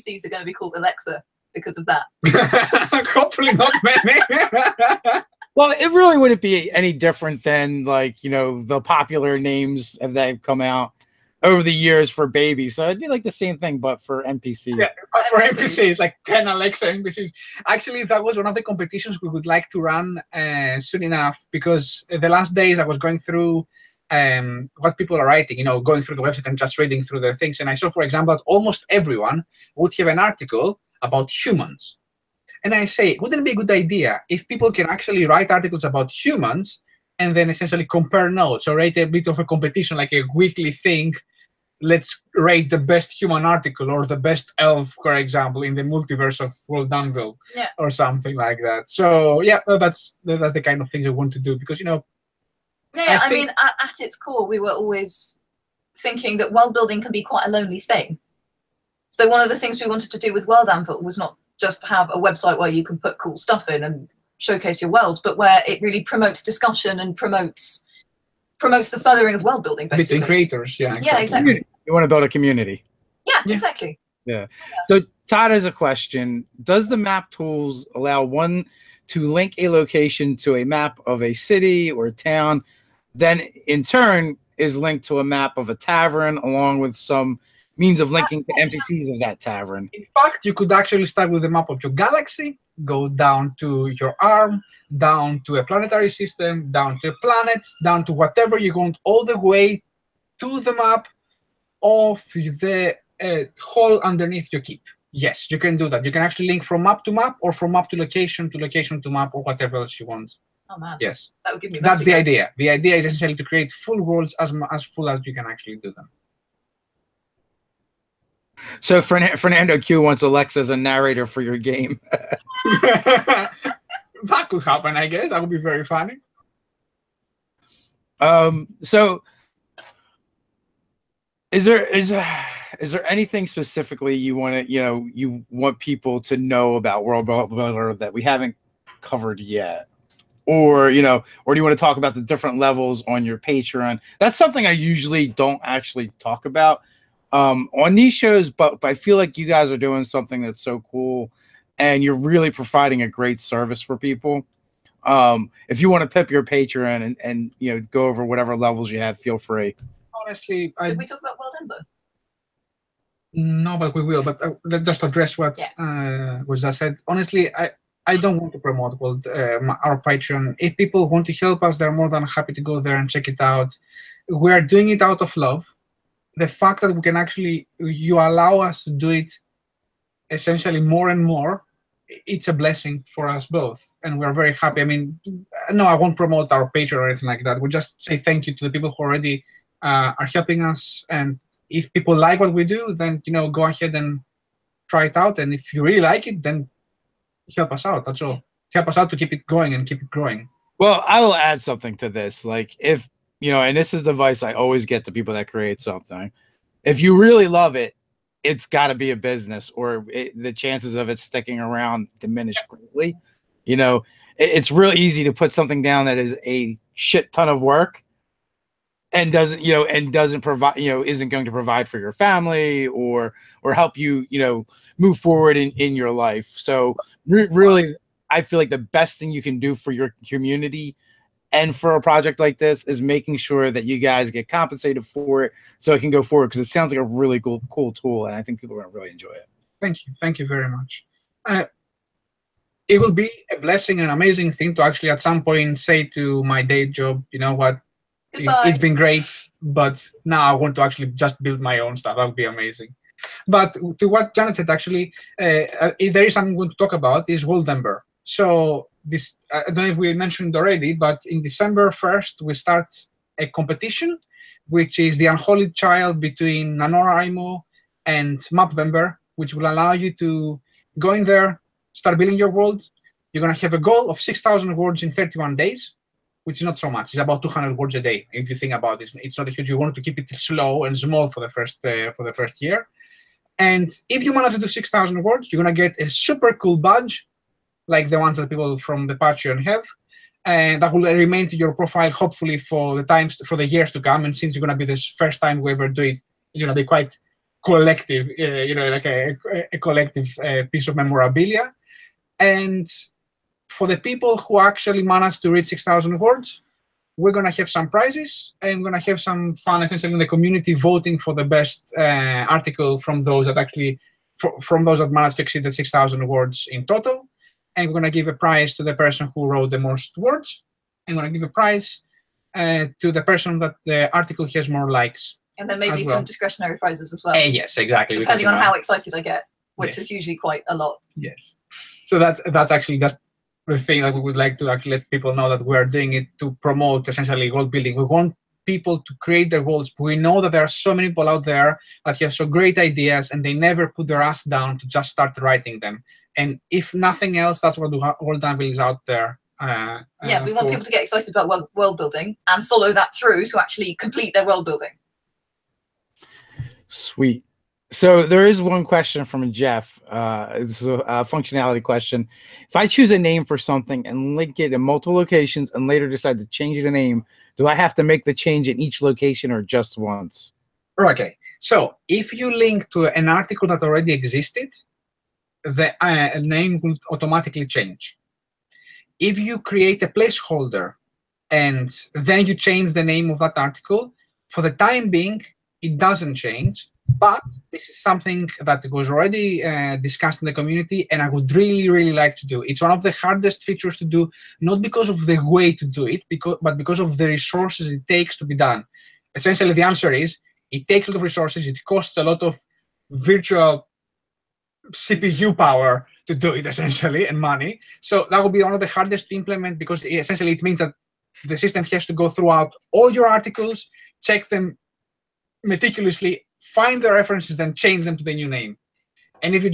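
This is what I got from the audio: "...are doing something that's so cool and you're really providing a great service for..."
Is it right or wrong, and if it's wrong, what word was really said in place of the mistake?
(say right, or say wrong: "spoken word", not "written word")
right.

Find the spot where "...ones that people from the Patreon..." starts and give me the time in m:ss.
4:48.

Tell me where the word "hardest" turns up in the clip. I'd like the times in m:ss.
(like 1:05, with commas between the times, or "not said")
6:33, 6:48.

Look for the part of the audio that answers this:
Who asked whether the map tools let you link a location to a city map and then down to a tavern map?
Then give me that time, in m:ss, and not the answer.
1:15.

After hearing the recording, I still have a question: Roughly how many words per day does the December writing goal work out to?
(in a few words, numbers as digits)
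200.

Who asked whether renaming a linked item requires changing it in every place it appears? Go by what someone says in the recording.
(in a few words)
Jeff.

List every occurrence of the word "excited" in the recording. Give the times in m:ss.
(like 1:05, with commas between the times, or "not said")
5:28, 5:51.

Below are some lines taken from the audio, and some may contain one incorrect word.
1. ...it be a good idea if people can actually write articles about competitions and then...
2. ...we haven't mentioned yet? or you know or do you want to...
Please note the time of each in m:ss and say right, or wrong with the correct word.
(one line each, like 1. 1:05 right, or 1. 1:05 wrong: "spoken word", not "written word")
1. 0:33 wrong: "humans", not "competitions"
2. 2:18 wrong: "covered", not "mentioned".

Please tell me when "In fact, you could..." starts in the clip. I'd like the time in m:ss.
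1:29.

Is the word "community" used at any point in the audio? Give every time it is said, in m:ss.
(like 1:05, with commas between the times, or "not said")
1:12, 3:50, 5:10, 6:30.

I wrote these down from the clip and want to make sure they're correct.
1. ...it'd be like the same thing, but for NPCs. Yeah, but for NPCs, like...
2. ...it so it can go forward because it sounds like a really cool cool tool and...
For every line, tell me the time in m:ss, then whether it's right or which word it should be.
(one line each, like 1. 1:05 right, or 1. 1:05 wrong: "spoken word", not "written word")
1. 0:12 right
2. 3:55 right.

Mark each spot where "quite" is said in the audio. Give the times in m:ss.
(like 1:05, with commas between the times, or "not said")
0:57, 4:56, 5:30.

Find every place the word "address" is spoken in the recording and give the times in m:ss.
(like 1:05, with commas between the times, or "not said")
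2:45.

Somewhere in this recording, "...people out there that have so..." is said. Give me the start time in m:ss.
5:41.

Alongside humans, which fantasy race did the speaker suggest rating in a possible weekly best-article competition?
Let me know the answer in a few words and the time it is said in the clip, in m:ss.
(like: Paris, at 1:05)
elf, at 0:44.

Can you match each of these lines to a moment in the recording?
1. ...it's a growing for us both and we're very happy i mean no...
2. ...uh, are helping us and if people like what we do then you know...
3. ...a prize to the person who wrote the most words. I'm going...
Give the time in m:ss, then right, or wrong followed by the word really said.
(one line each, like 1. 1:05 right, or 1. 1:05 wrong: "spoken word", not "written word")
1. 3:02 wrong: "blessing", not "growing"
2. 3:09 right
3. 5:18 right.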